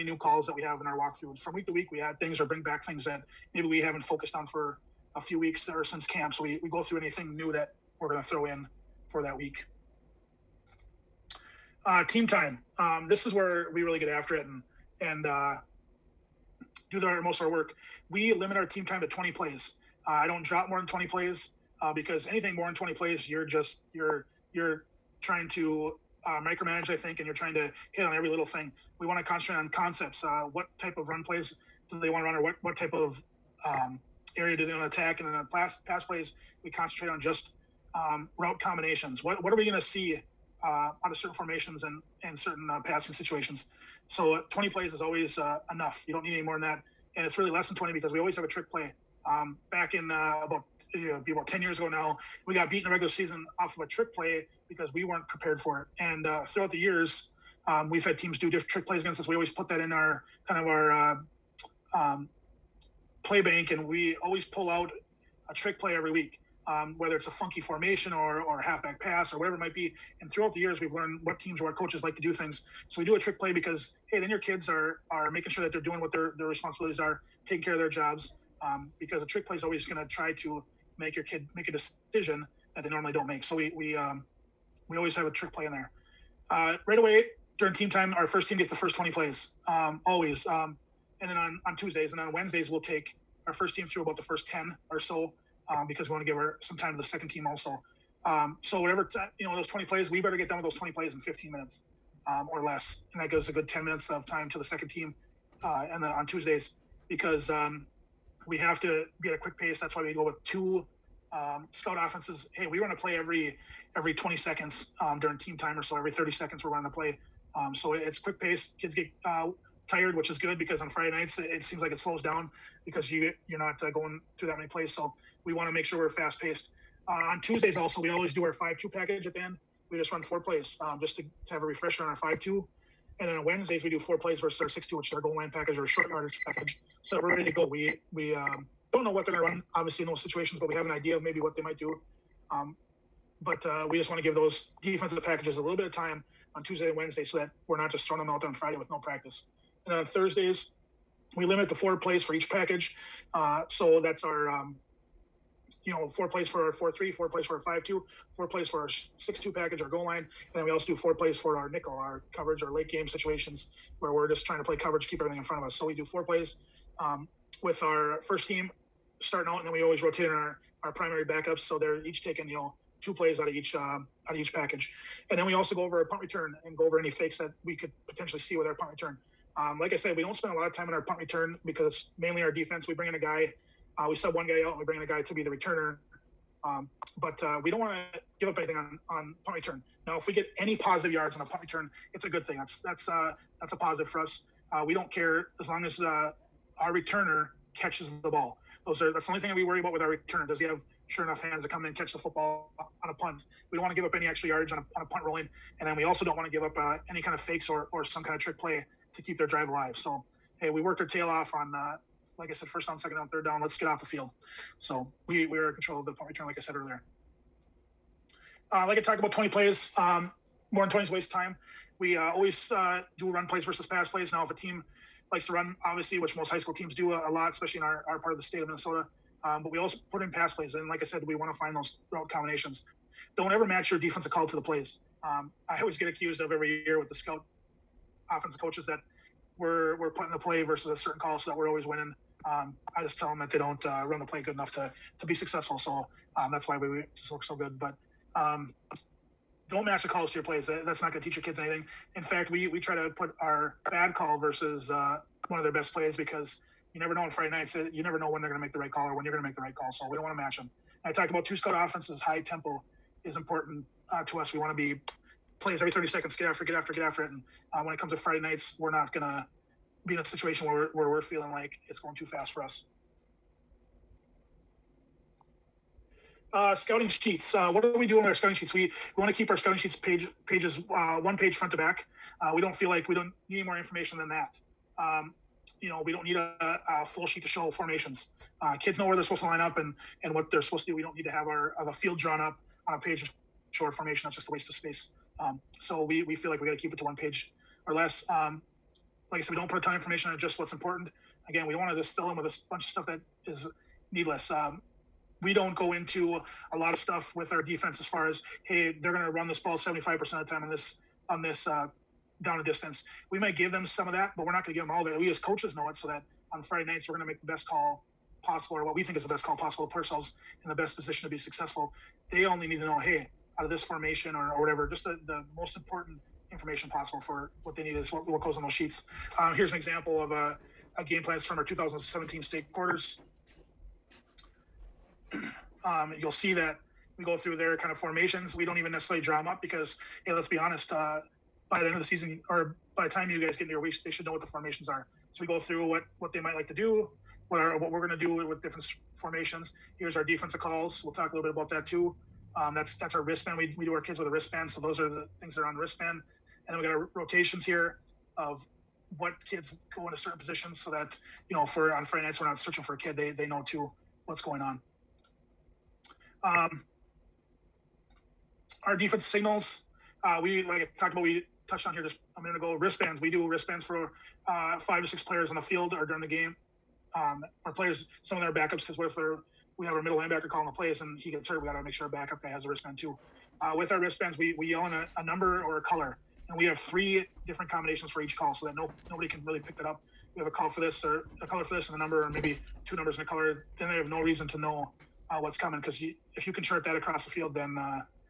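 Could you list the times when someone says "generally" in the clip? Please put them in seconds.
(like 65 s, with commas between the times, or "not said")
not said.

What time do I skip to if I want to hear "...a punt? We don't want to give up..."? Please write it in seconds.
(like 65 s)
203 s.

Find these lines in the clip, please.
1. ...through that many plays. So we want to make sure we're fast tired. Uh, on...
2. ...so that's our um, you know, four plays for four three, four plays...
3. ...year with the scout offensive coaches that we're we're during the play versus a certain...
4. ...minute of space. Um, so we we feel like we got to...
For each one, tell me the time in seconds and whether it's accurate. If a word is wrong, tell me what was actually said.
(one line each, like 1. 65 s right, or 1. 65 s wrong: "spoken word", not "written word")
1. 124 s wrong: "paced", not "tired"
2. 153 s right
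3. 236 s wrong: "putting", not "during"
4. 294 s wrong: "waste", not "minute".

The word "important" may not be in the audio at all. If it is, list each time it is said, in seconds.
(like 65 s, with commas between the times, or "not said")
263 s, 300 s, 325 s.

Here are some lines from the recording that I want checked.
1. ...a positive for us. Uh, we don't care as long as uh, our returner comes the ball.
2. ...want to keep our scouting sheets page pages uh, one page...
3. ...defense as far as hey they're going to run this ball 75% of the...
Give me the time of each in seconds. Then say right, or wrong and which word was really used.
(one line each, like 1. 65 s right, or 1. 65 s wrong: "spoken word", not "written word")
1. 193 s wrong: "catches", not "comes"
2. 279 s right
3. 307 s right.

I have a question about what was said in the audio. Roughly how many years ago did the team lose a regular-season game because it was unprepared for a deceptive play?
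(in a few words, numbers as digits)
10.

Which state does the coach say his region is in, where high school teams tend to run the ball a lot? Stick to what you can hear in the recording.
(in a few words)
Minnesota.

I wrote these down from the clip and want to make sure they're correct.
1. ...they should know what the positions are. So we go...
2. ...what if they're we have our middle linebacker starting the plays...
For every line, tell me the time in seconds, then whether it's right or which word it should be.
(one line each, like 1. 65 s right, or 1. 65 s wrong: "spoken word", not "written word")
1. 344 s wrong: "formations", not "positions"
2. 378 s wrong: "calling", not "starting".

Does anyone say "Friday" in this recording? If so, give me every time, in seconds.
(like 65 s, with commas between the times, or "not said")
120 s, 148 s, 257 s, 268 s, 316 s, 362 s.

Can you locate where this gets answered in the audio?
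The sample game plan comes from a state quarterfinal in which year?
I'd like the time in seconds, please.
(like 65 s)
331 s.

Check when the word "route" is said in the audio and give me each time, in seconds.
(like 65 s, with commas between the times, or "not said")
38 s, 232 s.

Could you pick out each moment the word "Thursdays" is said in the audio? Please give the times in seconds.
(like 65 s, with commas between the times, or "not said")
150 s.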